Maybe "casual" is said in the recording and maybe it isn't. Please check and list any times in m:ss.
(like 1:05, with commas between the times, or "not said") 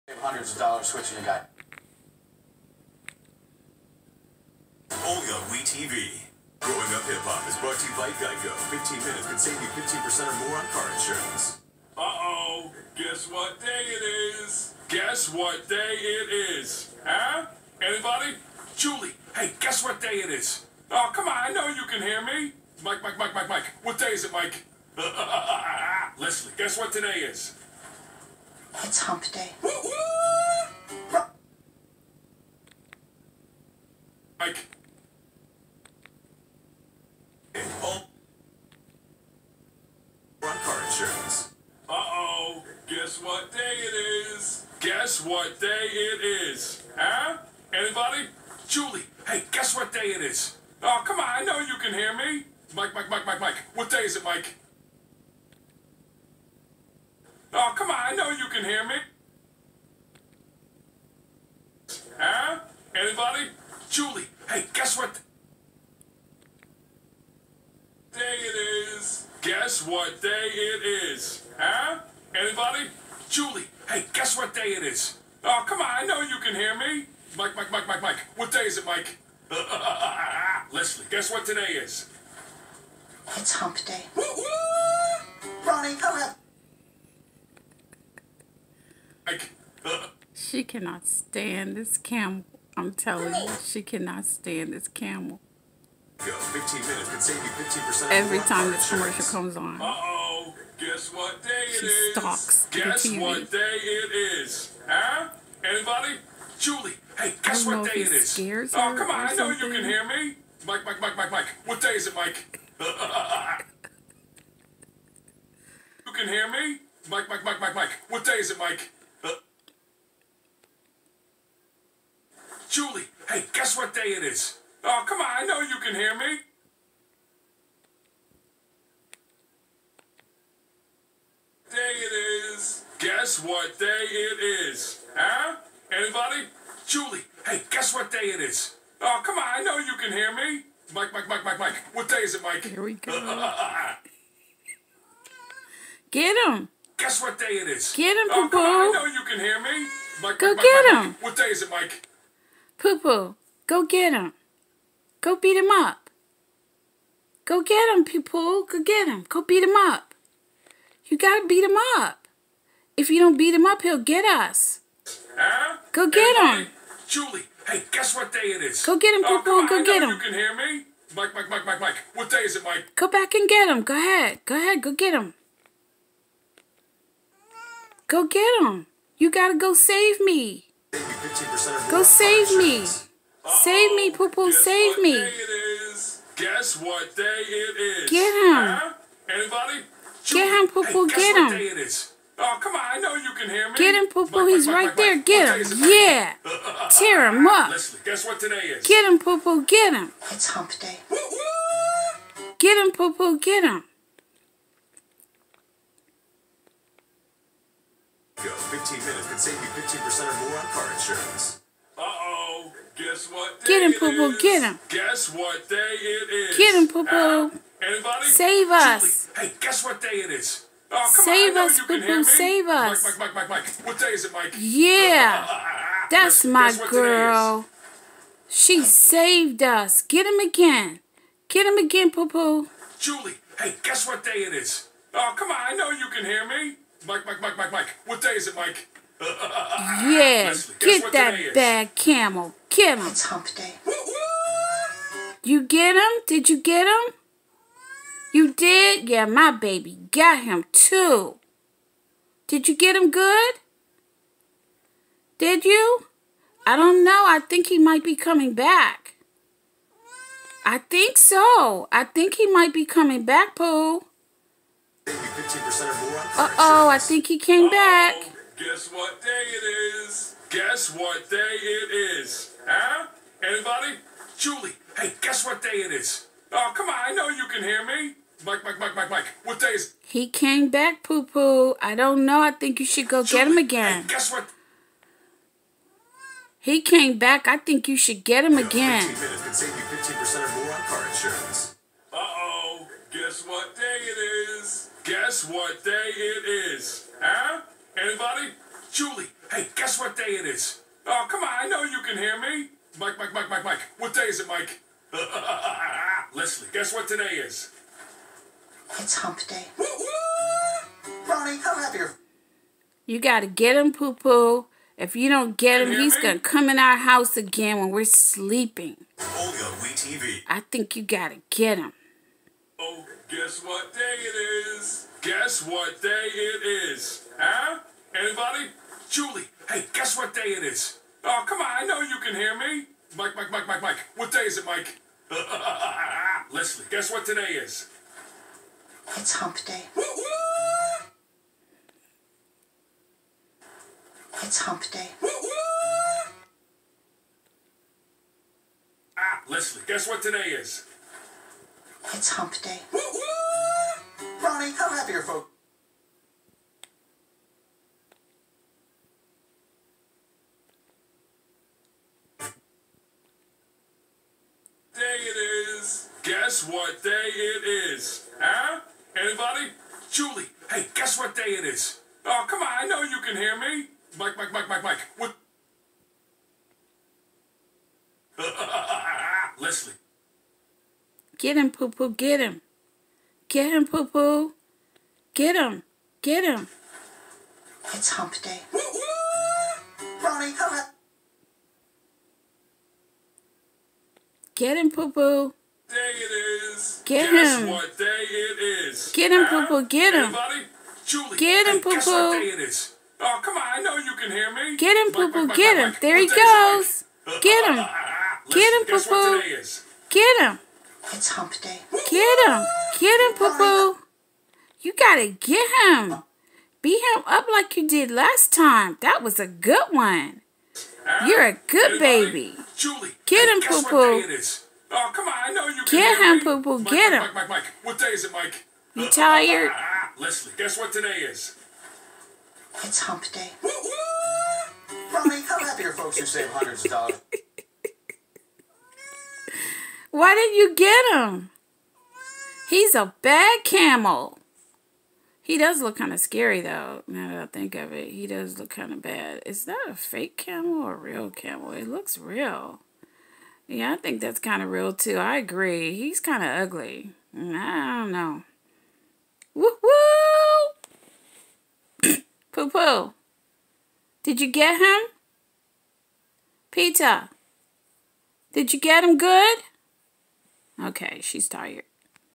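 not said.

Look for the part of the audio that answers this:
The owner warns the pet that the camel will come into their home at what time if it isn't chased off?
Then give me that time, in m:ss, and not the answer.
5:17.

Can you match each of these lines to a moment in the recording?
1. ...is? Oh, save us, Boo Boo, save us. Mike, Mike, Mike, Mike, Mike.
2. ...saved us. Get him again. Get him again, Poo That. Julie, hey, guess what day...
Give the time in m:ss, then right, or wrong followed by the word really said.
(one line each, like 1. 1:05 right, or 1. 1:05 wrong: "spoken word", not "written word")
1. 3:40 right
2. 3:48 wrong: "Poo", not "That".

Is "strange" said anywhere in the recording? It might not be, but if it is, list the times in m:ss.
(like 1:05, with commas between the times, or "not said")
not said.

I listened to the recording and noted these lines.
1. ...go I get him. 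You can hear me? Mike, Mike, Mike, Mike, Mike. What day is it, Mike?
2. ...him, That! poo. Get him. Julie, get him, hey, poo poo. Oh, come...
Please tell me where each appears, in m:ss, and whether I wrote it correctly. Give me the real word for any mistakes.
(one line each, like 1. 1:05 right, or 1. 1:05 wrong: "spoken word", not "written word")
1. 2:49 right
2. 6:39 wrong: "Poopoo", not "That".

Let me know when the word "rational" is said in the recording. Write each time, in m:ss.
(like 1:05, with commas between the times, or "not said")
not said.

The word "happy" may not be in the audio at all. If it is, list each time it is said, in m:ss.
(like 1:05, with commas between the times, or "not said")
5:11, 5:54, 7:15.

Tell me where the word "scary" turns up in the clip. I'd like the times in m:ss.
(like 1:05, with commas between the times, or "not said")
7:26.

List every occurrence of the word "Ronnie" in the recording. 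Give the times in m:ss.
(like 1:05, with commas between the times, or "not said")
1:25, 5:11, 5:54, 6:30, 7:15.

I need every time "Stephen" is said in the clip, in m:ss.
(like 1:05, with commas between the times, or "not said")
not said.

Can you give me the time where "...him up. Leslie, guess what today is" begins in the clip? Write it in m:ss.
3:17.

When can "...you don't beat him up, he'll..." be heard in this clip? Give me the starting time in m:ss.
2:43.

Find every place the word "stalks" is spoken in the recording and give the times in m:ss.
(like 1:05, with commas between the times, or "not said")
1:42.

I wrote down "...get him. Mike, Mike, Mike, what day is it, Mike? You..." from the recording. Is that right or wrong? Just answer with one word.
right.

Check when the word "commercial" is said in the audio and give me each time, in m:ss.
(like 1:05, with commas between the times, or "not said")
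1:38.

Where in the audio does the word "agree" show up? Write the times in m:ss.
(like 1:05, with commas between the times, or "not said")
7:35.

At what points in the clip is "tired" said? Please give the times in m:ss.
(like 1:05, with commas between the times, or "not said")
7:09, 7:51.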